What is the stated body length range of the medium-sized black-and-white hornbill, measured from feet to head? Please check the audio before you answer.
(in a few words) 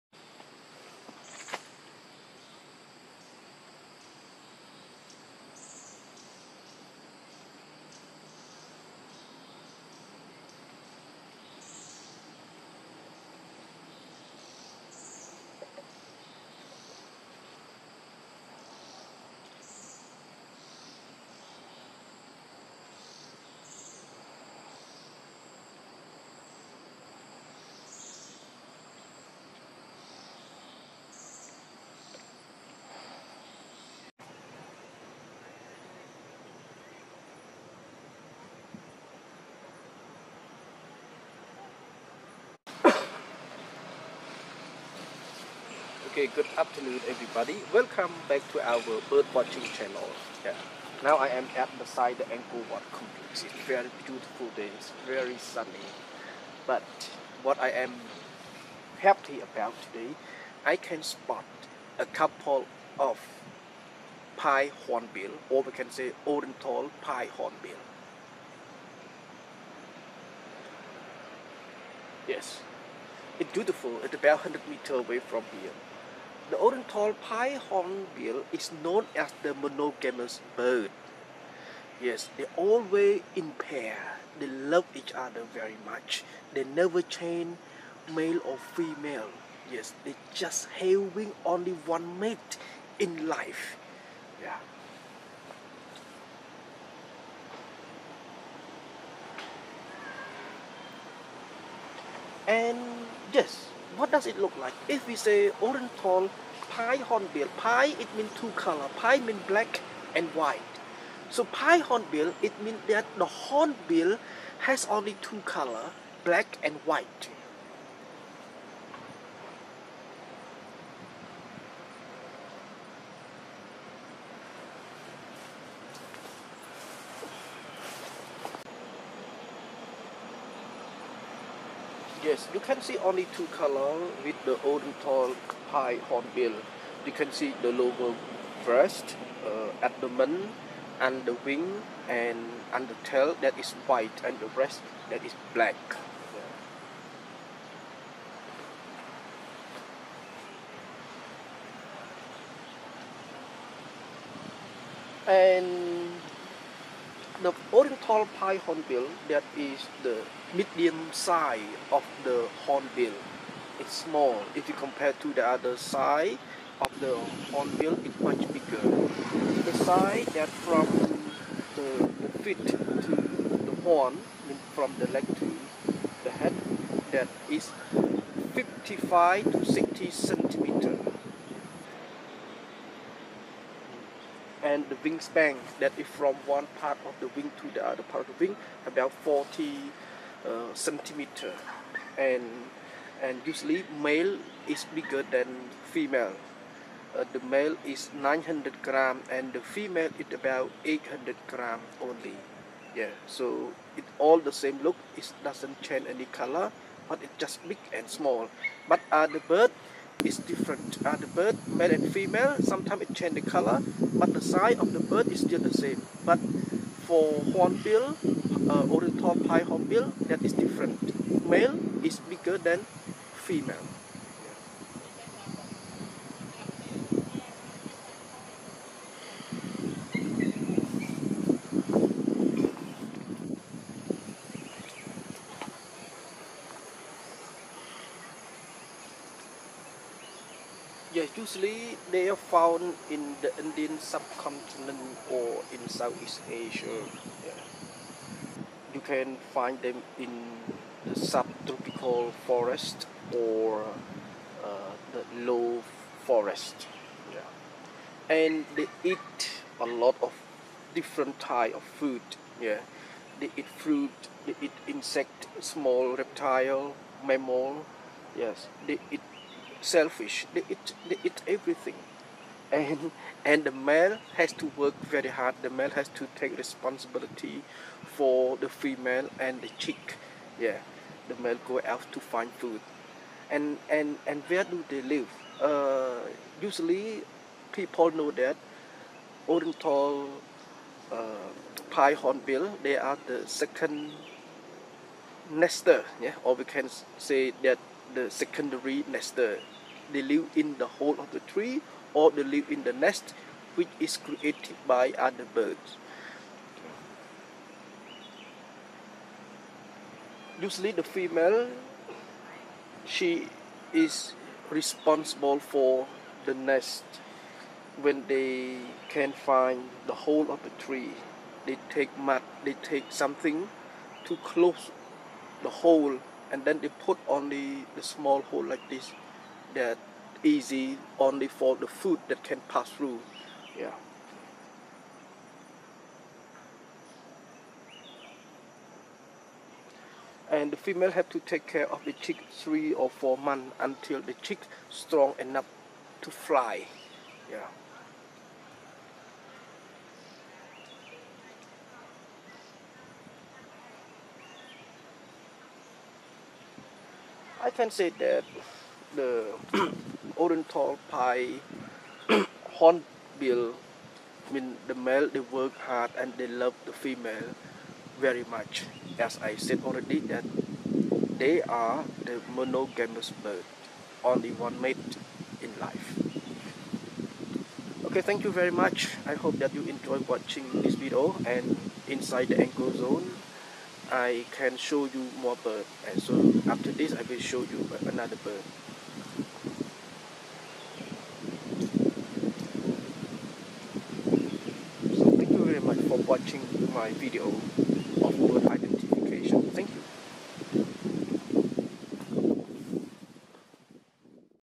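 55 to 60 centimeters.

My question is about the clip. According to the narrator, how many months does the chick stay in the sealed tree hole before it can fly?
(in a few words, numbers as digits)
3 or 4 months.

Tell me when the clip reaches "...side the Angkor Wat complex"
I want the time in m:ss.
0:51.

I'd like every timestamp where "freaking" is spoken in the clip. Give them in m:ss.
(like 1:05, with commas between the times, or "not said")
not said.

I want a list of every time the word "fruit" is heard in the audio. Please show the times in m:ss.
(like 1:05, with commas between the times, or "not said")
4:23.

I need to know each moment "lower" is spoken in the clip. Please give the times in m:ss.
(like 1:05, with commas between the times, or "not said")
2:17.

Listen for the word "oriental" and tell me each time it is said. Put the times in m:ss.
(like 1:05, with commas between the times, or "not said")
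1:06, 1:16, 1:45, 2:37, 3:38, 4:49, 6:00.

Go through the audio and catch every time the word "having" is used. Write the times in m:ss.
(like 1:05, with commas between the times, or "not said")
1:30.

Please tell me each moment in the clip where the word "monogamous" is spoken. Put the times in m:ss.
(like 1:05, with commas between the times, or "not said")
1:19, 6:12.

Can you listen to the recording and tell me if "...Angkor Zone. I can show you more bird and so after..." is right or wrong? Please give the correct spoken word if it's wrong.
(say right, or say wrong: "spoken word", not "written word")
right.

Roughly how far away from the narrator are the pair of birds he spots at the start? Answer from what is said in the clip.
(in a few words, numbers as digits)
100 meters.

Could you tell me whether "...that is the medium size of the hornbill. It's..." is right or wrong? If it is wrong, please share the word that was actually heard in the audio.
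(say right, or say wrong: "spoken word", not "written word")
right.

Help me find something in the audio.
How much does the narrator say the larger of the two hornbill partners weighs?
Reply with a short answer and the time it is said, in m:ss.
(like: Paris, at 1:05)
900 grams, at 3:18.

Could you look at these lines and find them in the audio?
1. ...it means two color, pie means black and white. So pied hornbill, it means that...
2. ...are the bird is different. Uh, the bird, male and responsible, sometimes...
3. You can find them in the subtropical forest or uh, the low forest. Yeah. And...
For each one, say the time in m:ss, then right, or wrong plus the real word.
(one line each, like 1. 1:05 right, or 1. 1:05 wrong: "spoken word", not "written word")
1. 1:47 right
2. 3:29 wrong: "female", not "responsible"
3. 4:08 right.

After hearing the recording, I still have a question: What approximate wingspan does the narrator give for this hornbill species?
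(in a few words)
40 centimeters.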